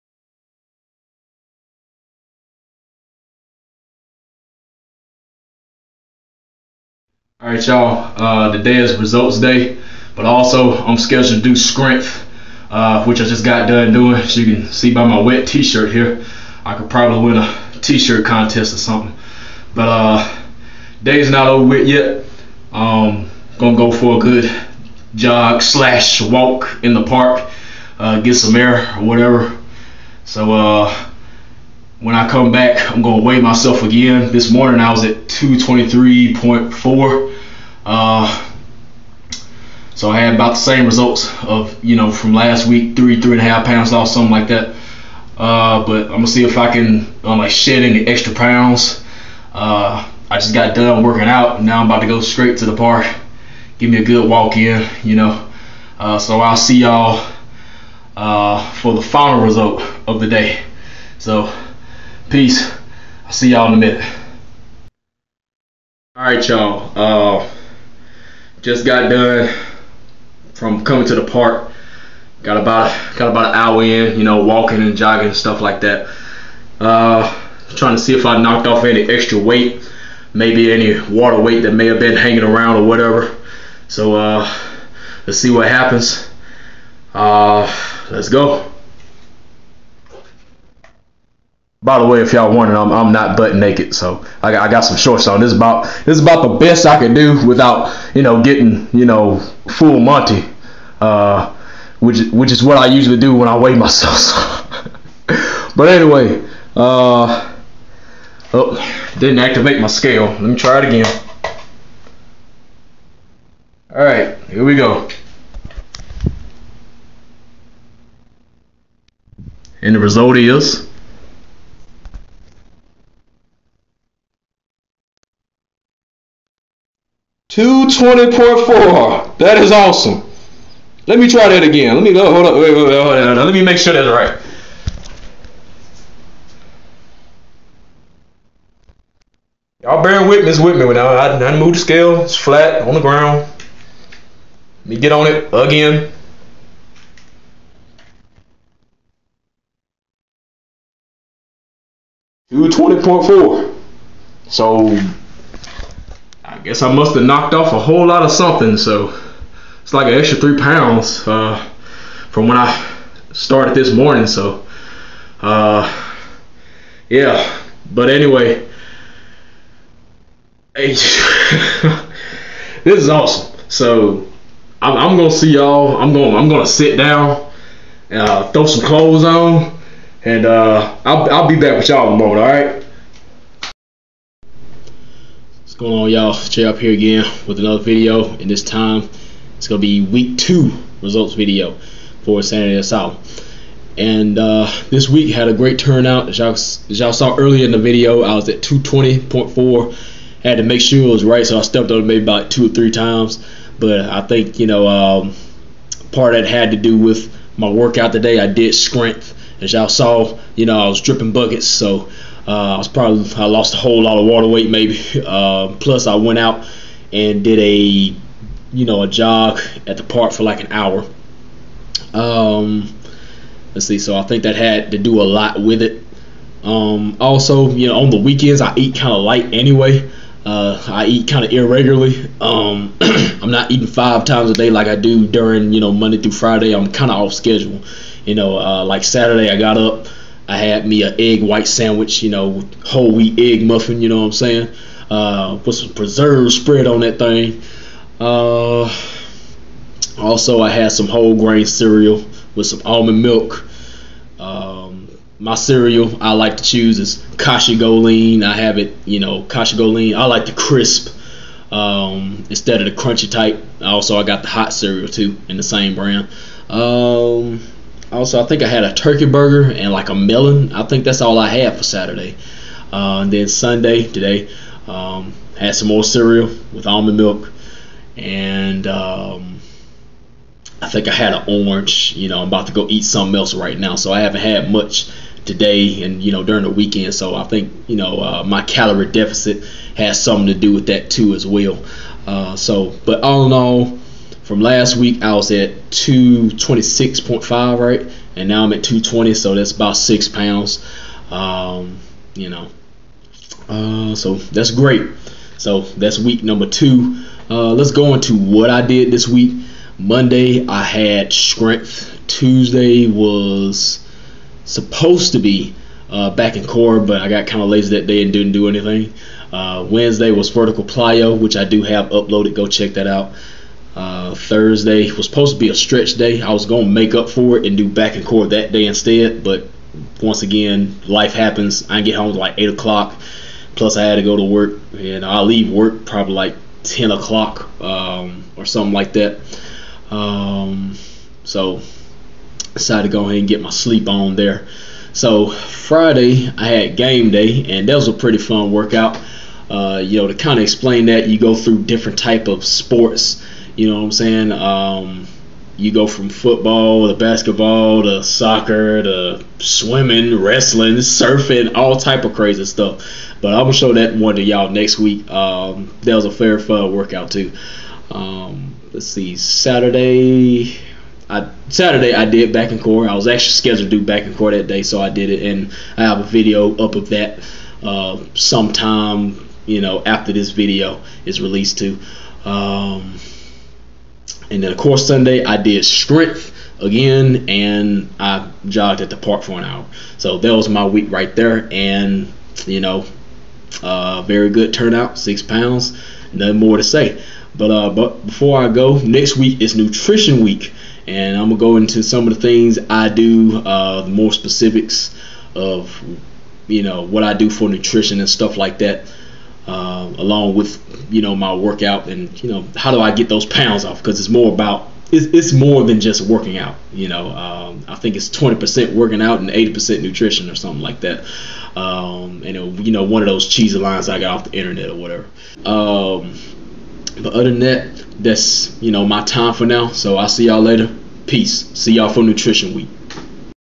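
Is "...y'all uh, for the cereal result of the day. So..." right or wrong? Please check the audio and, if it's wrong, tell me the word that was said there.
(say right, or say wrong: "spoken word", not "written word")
wrong: "final", not "cereal".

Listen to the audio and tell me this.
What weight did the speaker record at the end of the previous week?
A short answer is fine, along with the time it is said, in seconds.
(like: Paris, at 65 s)
226.5, at 295 s.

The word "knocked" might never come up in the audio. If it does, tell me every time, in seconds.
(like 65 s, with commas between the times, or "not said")
78 s, 157 s.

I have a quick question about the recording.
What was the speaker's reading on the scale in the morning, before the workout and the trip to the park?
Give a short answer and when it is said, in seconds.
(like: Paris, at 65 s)
223.4, at 35 s.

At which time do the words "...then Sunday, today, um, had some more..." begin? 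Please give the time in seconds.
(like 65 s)
273 s.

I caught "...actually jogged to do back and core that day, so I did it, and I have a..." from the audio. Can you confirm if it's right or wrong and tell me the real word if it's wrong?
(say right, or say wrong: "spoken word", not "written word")
wrong: "scheduled", not "jogged".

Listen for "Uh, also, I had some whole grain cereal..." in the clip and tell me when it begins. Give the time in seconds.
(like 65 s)
248 s.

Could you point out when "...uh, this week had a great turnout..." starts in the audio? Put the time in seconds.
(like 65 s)
194 s.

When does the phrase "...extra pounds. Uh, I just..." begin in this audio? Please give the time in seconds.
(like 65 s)
48 s.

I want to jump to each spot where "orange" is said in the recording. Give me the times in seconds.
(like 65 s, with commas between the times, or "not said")
281 s.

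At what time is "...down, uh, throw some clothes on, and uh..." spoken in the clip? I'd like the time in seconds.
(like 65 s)
176 s.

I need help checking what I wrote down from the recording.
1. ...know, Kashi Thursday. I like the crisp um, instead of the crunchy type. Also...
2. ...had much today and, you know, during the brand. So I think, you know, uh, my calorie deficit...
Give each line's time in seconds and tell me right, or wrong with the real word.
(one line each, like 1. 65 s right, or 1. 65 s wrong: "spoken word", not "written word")
1. 259 s wrong: "GoLean", not "Thursday"
2. 284 s wrong: "weekend", not "brand".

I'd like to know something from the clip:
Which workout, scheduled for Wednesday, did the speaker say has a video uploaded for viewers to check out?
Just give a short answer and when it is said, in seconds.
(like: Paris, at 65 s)
Vertical plyo, at 320 s.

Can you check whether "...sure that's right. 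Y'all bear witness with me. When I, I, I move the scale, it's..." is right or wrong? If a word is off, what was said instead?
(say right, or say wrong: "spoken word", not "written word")
right.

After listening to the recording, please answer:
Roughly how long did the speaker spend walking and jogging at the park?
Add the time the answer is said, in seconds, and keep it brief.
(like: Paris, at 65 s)
About an hour, at 73 s.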